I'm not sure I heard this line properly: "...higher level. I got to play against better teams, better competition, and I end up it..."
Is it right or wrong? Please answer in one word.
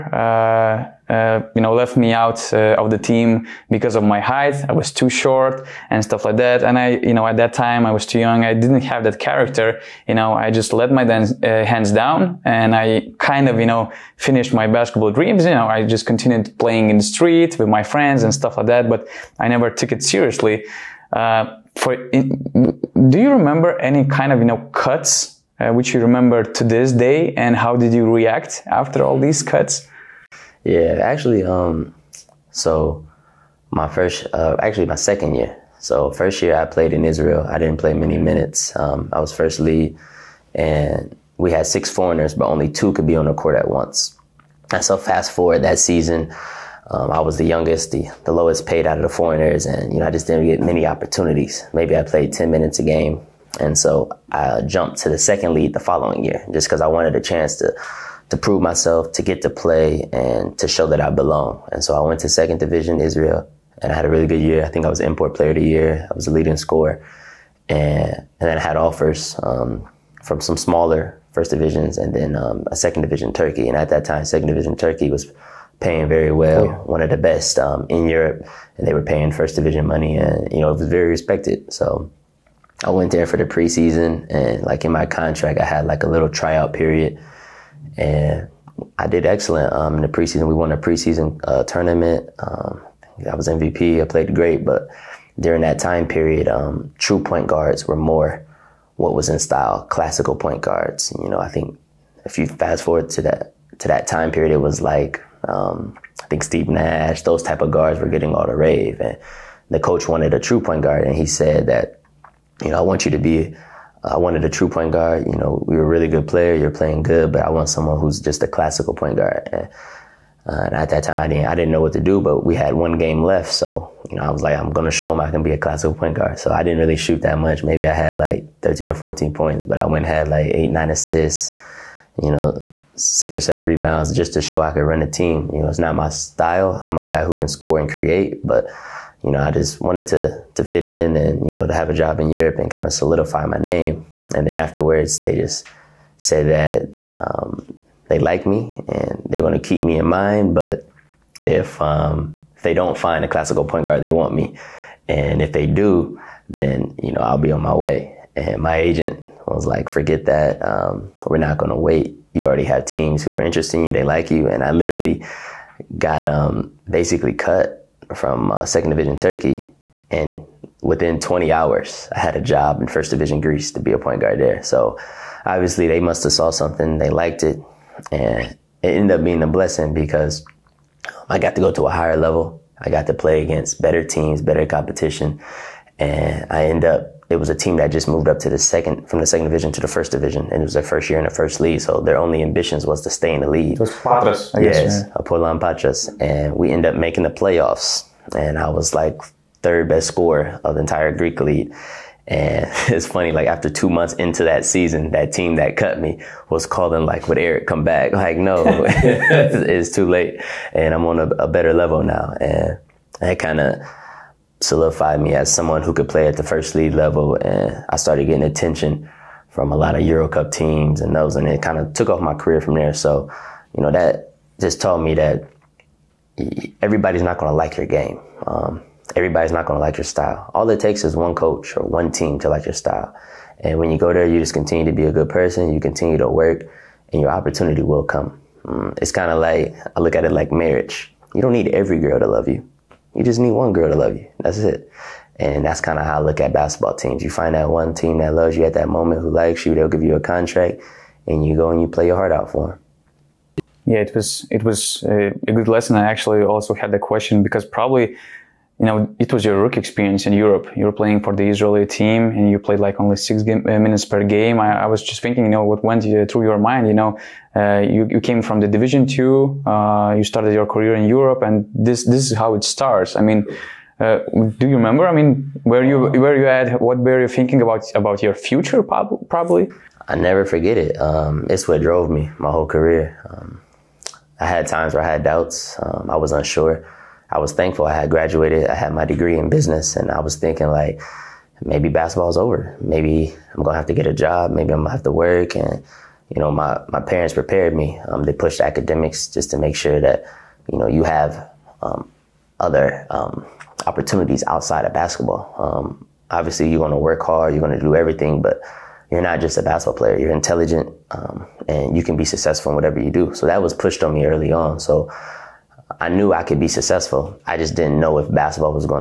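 right.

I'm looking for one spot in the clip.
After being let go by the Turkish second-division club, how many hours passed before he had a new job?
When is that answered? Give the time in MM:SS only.
02:51.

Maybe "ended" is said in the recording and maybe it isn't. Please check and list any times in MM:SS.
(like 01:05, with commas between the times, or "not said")
02:58, 03:16.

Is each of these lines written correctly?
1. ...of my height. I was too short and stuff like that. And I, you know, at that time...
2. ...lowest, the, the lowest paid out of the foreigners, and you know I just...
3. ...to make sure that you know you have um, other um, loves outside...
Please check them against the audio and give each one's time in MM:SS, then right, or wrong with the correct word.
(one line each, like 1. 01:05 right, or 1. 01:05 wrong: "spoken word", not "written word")
1. 00:03 right
2. 00:47 wrong: "youngest", not "lowest"
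3. 04:59 wrong: "opportunities", not "loves".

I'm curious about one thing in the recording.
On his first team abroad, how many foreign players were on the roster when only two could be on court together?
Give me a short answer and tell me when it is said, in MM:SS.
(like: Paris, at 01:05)
6, at 00:41.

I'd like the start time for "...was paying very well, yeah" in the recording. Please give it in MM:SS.
01:15.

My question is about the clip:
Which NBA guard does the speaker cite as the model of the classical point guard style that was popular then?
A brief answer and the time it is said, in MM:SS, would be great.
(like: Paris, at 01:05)
Steve Nash, at 01:46.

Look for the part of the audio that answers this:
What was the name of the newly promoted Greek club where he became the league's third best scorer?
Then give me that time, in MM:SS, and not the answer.
03:15.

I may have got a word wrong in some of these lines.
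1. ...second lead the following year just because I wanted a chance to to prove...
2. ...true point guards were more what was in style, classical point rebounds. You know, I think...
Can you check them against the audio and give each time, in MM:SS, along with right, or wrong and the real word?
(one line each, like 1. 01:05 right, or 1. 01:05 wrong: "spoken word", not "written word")
1. 00:55 right
2. 01:36 wrong: "guards", not "rebounds".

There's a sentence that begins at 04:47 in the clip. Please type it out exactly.
I was thankful I had graduated, I had my degree in business, and I was thinking like maybe basketball's over.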